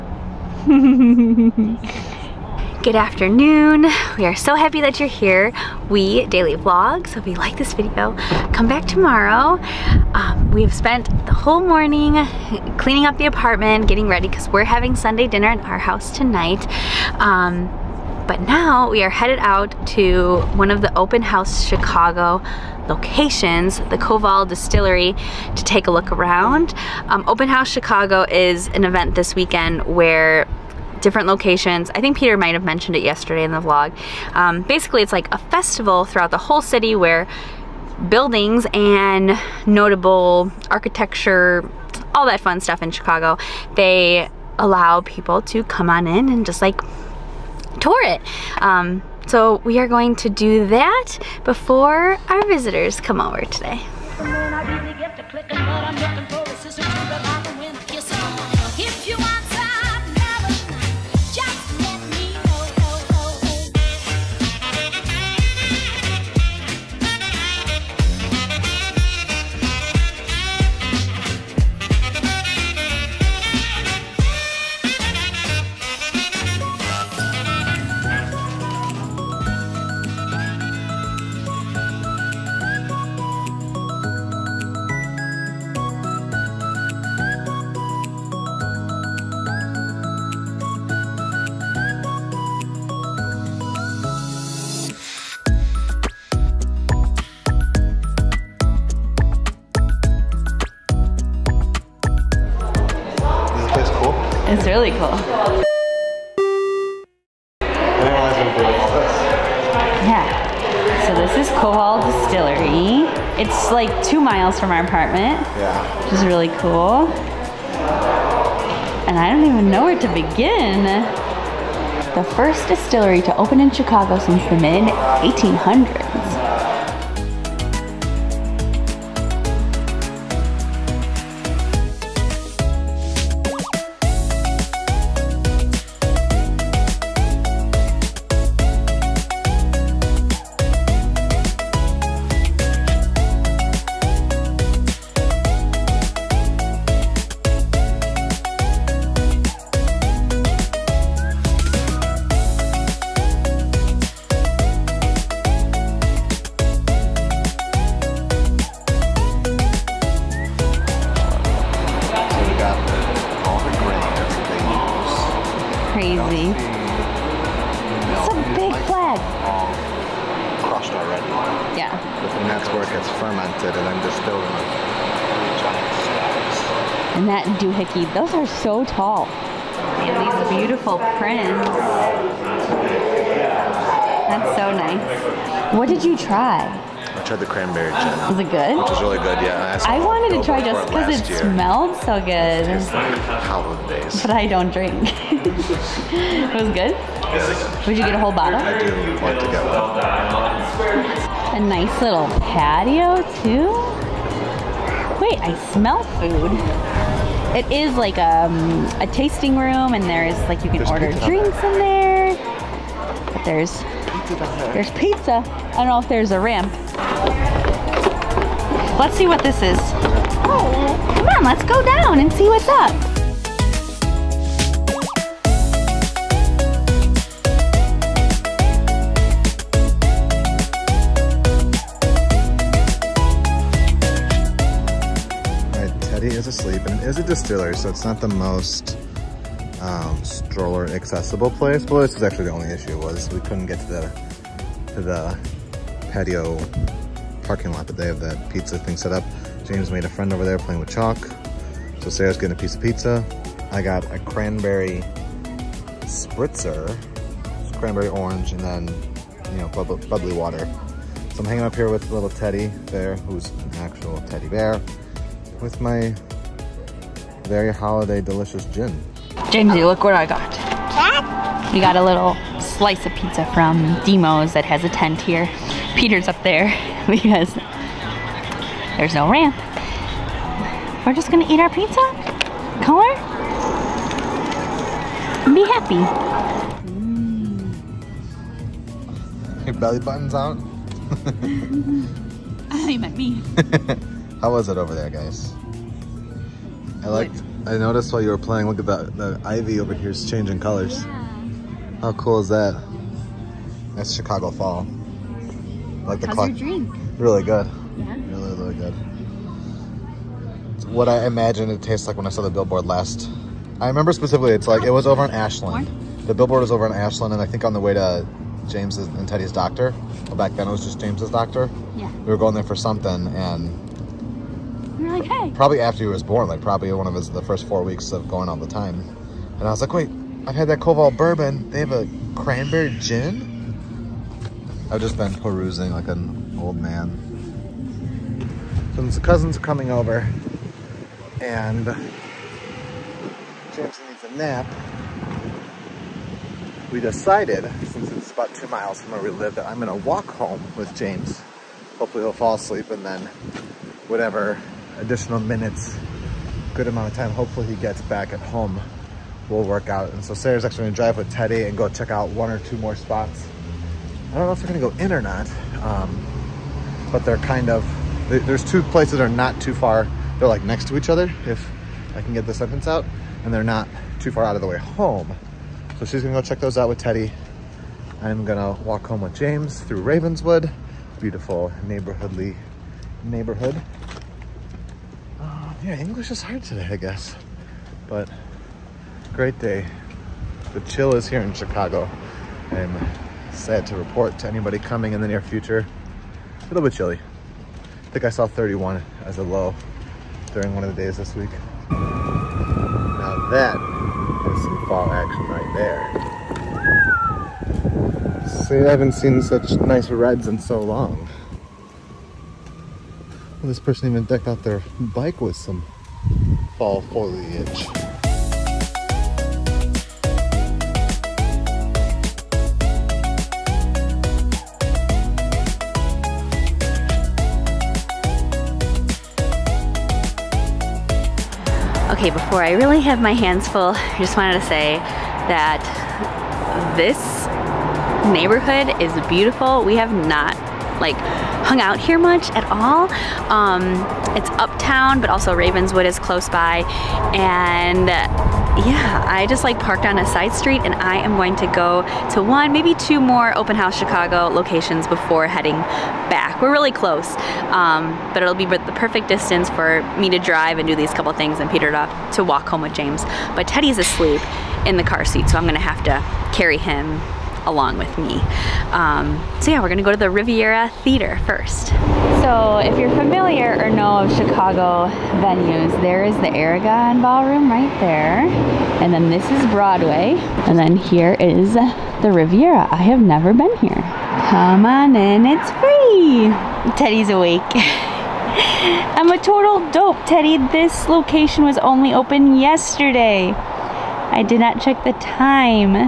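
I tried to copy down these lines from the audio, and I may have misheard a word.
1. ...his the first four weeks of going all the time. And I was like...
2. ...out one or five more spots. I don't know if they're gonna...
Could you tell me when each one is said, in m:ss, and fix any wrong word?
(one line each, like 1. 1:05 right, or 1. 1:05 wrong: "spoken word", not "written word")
1. 5:27 right
2. 6:02 wrong: "two", not "five".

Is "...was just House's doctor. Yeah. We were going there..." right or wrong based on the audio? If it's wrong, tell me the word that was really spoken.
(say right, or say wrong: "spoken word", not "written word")
wrong: "James", not "House".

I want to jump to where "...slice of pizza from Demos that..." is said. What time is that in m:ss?
4:32.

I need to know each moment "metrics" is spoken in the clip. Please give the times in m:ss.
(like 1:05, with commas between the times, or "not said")
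not said.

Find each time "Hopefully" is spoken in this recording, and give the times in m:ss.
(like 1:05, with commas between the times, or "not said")
5:51, 5:57.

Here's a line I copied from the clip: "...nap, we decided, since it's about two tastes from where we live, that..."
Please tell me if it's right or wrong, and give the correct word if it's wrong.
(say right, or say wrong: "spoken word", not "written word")
wrong: "miles", not "tastes".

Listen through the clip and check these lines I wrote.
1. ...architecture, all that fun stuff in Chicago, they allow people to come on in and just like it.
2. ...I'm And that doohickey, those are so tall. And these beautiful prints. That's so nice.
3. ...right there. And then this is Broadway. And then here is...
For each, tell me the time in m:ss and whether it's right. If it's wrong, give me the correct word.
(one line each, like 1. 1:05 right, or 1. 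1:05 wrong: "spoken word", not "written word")
1. 0:40 right
2. 2:53 right
3. 7:57 right.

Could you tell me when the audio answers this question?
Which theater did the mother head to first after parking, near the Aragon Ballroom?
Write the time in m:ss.
7:50.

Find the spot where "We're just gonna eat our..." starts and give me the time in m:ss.
4:41.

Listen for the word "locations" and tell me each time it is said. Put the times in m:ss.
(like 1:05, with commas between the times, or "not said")
0:22, 0:31, 7:34, 8:11.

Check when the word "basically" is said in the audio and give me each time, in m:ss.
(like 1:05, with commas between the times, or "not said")
0:34.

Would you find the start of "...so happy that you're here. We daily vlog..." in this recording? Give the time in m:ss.
0:04.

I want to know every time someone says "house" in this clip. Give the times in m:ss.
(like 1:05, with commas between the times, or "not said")
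0:15, 0:21, 0:27, 7:33.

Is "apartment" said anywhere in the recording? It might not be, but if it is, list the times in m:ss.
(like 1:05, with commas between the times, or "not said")
0:13, 1:54.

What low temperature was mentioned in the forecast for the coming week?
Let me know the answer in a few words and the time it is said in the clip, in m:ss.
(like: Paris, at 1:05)
31, at 6:38.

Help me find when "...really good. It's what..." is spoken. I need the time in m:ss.
5:08.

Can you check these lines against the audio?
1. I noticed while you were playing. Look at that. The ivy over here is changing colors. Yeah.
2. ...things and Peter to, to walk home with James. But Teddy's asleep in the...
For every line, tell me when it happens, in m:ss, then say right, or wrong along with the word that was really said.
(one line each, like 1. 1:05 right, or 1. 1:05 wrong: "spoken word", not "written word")
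1. 4:57 right
2. 7:41 right.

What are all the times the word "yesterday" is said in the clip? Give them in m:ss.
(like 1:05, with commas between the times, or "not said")
0:33, 8:12.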